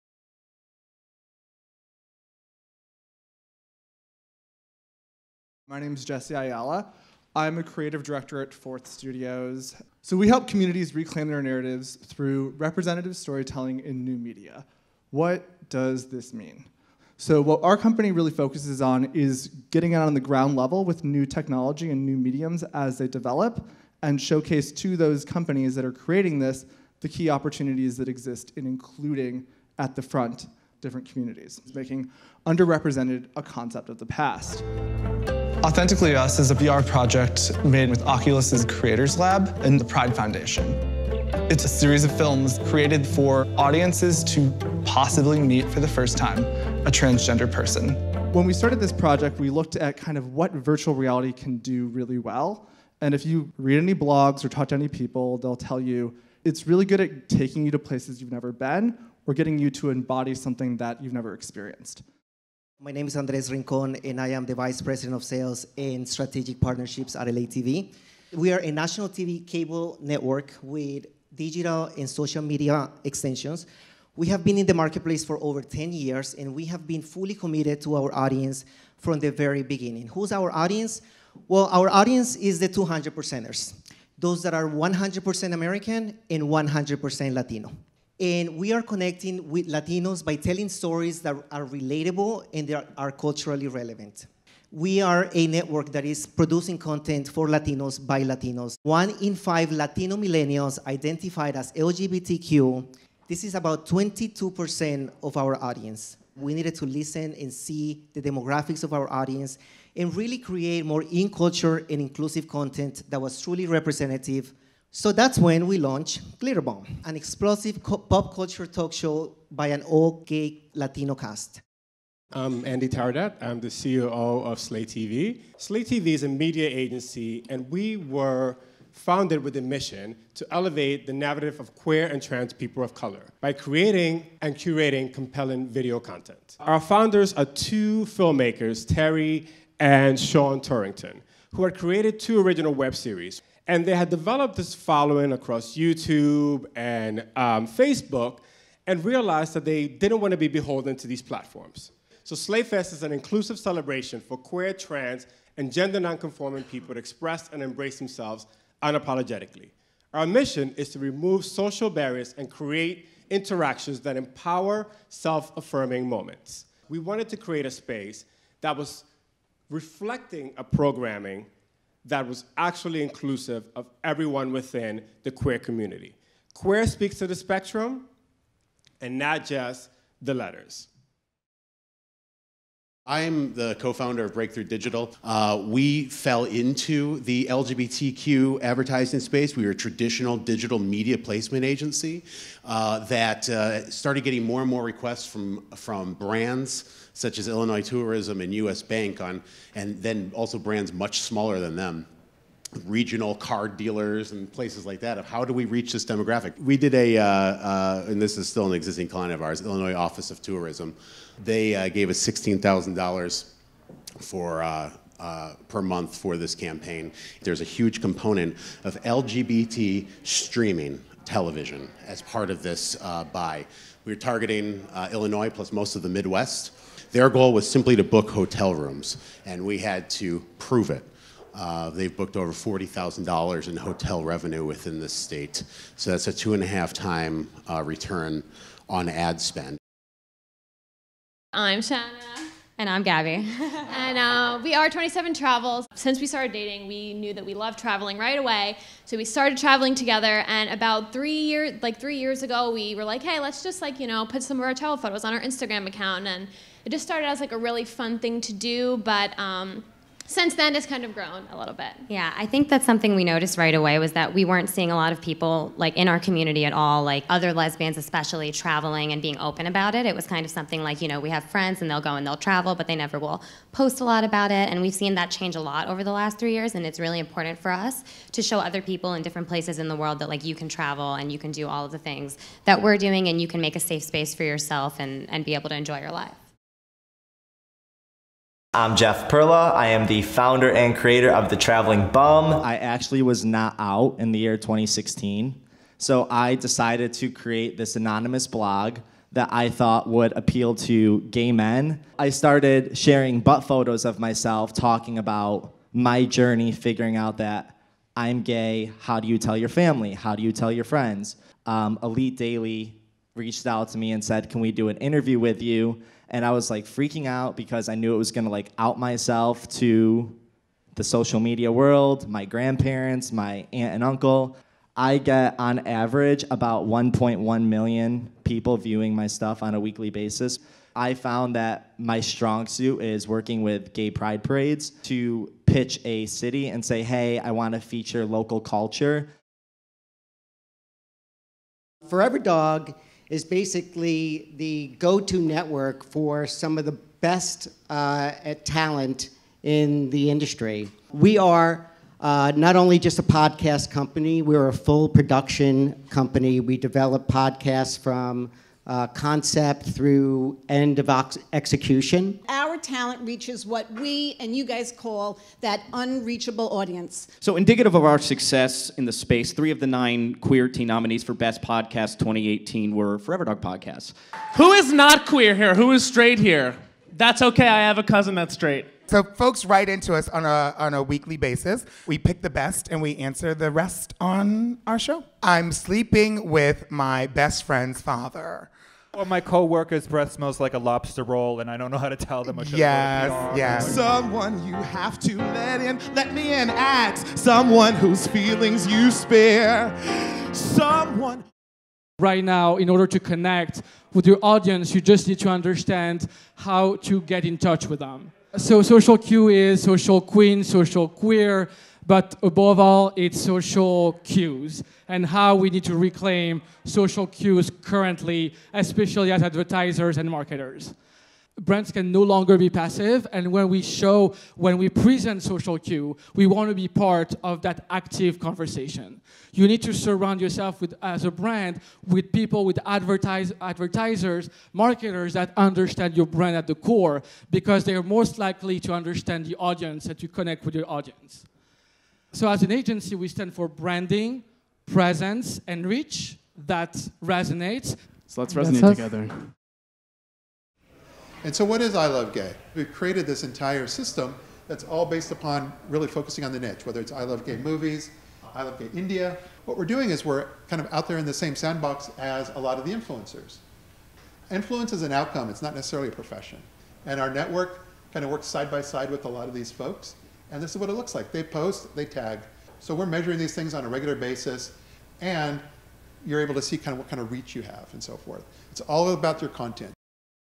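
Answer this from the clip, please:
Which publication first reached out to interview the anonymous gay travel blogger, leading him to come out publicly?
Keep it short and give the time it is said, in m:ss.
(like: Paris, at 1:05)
Elite Daily, at 5:12.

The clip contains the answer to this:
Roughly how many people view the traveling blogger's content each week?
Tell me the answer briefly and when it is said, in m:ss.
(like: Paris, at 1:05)
1.1 million, at 5:26.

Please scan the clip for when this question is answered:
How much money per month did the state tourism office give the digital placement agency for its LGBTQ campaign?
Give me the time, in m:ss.
3:32.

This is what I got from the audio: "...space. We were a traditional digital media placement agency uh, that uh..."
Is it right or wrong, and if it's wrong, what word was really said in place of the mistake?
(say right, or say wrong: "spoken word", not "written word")
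right.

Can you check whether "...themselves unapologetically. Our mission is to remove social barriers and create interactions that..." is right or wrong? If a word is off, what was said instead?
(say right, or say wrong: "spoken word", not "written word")
right.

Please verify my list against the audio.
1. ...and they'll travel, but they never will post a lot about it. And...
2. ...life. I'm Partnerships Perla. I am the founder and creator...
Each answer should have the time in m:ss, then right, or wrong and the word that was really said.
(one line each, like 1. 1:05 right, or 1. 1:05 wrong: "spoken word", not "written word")
1. 4:32 right
2. 4:46 wrong: "Jeff", not "Partnerships".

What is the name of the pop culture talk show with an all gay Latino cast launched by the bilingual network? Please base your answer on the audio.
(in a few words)
Glitterbomb.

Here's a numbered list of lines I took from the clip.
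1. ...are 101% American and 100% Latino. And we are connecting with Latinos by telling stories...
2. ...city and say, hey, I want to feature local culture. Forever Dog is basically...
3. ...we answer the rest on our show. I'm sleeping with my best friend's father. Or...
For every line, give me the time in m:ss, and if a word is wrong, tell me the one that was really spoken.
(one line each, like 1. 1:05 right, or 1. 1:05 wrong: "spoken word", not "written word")
1. 1:24 wrong: "100", not "101"
2. 5:36 right
3. 6:23 right.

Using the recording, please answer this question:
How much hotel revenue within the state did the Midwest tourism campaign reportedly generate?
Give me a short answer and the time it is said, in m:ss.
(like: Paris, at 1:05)
$40,000, at 3:52.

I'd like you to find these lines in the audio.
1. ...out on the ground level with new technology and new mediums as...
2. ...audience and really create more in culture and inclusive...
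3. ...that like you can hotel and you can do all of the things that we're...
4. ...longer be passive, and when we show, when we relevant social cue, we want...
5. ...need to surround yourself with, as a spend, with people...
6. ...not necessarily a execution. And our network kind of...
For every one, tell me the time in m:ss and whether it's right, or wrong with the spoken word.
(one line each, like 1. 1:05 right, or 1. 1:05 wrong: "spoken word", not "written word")
1. 0:19 right
2. 1:49 right
3. 4:40 wrong: "travel", not "hotel"
4. 7:02 wrong: "present", not "relevant"
5. 7:09 wrong: "brand", not "spend"
6. 7:45 wrong: "profession", not "execution".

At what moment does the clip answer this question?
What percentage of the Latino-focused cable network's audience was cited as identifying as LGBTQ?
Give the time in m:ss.
1:43.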